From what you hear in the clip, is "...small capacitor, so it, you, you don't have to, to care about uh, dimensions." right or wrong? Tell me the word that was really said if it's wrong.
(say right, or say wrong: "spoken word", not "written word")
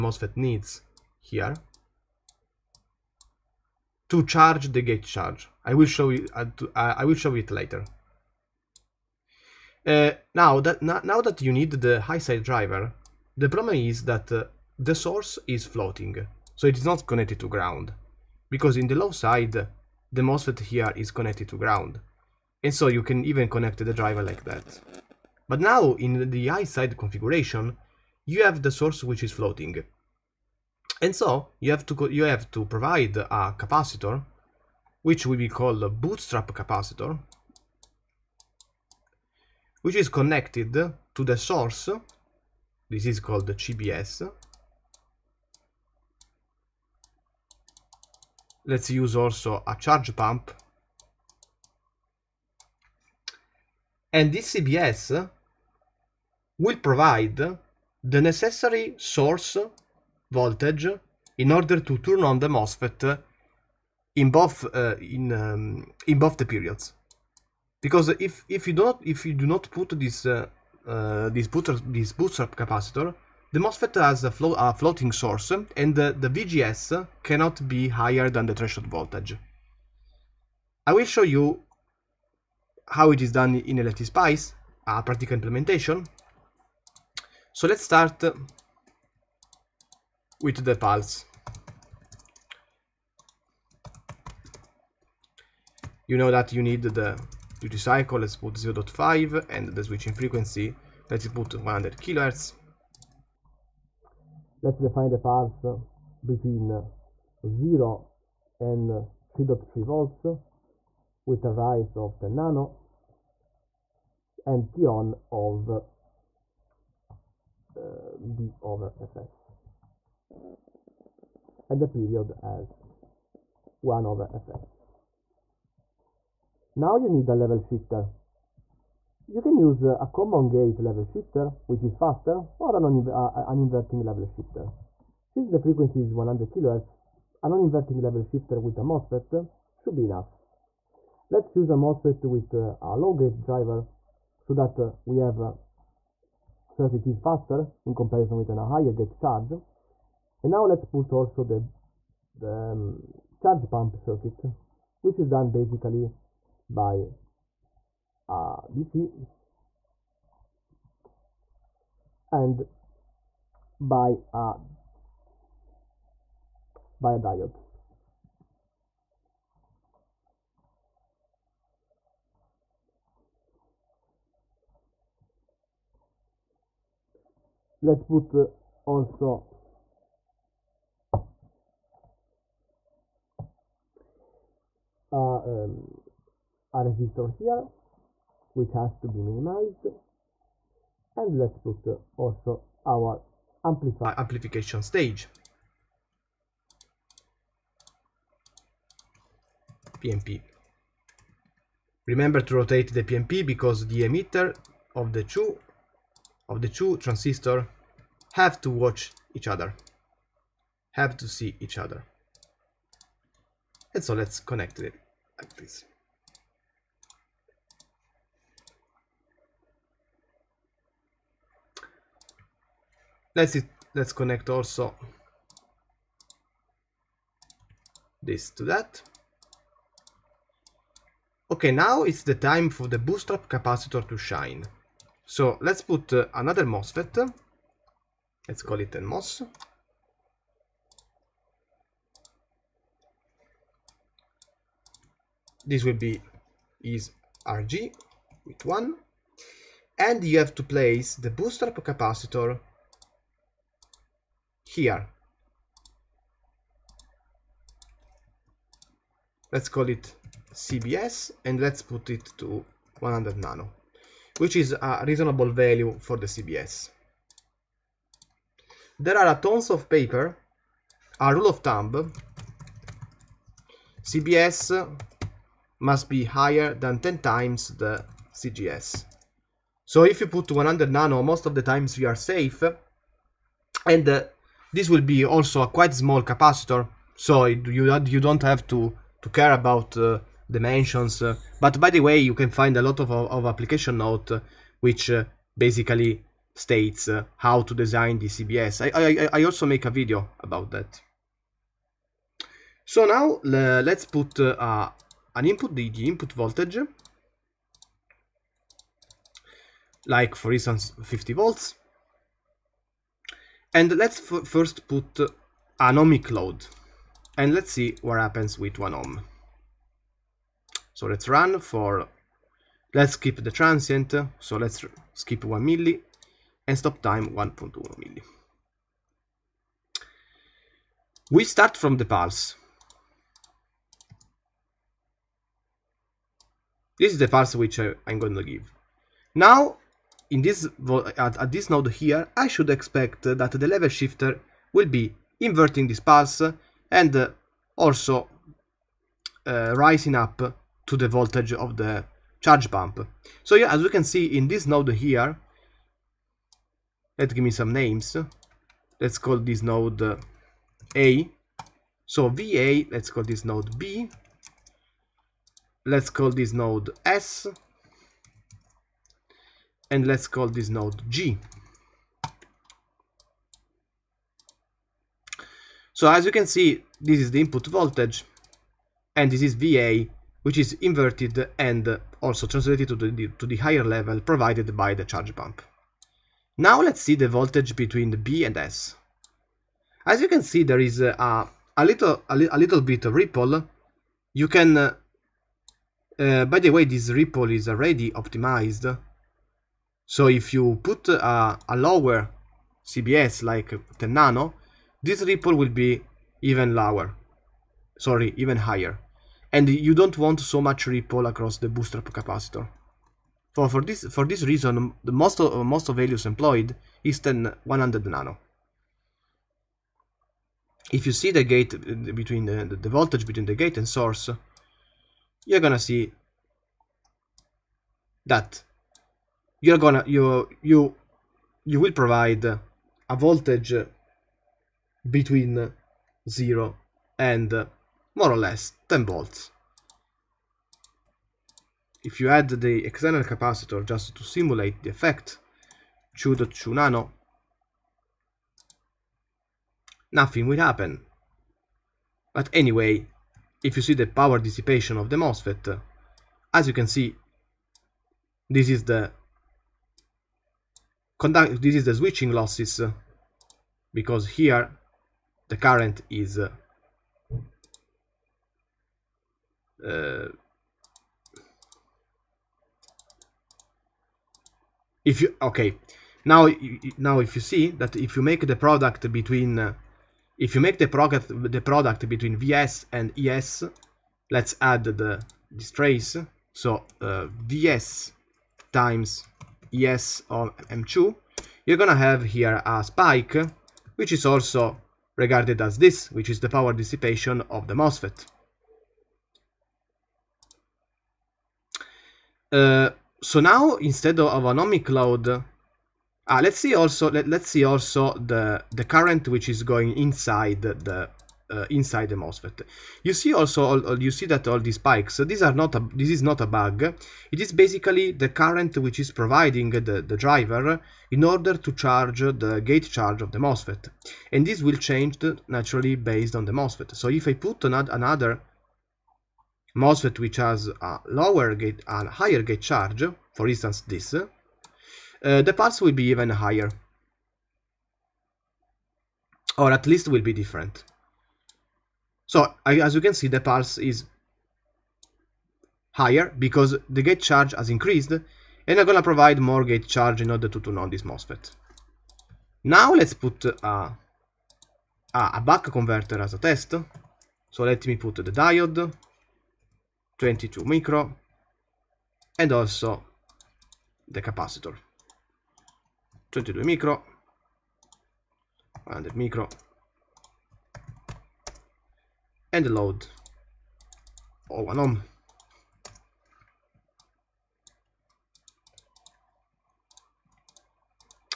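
right.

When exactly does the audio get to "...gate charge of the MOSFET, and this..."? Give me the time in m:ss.
8:42.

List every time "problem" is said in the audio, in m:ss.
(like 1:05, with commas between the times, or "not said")
0:13.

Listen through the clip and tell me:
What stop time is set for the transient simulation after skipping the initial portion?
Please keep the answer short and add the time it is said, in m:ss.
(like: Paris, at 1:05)
1.1 milli, at 5:27.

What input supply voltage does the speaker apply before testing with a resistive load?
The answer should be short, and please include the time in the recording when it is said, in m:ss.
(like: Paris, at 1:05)
50 volts, at 5:11.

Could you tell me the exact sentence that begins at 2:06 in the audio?
Now you need a level shifter.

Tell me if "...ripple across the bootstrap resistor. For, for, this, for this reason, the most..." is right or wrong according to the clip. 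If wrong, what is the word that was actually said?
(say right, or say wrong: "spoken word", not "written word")
wrong: "capacitor", not "resistor".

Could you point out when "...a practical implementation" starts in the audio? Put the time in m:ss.
1:24.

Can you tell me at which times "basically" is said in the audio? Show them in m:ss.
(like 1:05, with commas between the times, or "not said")
2:35, 4:55, 8:37.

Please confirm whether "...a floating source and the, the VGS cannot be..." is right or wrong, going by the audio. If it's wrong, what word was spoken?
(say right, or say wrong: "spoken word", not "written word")
right.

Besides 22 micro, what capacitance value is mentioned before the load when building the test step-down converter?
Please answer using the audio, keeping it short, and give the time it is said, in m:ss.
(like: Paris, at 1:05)
100 micro, at 9:28.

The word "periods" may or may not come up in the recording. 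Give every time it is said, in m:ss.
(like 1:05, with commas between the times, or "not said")
1:06, 2:01.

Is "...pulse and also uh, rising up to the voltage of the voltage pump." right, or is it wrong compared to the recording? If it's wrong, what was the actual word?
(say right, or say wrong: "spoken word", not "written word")
wrong: "charge", not "voltage".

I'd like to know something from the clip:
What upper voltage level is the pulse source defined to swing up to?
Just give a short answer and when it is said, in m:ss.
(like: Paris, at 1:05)
3.3 volts, at 1:48.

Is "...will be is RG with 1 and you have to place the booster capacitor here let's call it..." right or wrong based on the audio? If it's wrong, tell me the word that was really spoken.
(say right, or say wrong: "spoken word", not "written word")
right.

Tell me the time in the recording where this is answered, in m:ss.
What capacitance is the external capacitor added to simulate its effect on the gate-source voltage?
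7:26.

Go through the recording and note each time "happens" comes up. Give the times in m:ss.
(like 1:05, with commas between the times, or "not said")
5:18, 7:30.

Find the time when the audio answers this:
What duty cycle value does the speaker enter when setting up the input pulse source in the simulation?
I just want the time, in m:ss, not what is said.
1:38.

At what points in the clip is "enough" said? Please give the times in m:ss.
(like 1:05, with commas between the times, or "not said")
2:20.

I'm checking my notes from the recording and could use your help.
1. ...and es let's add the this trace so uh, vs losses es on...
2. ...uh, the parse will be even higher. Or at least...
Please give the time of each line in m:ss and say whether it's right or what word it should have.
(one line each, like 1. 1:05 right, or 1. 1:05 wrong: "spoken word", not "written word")
1. 8:02 wrong: "times", not "losses"
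2. 8:55 wrong: "pulse", not "parse".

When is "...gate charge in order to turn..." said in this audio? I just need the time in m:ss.
9:09.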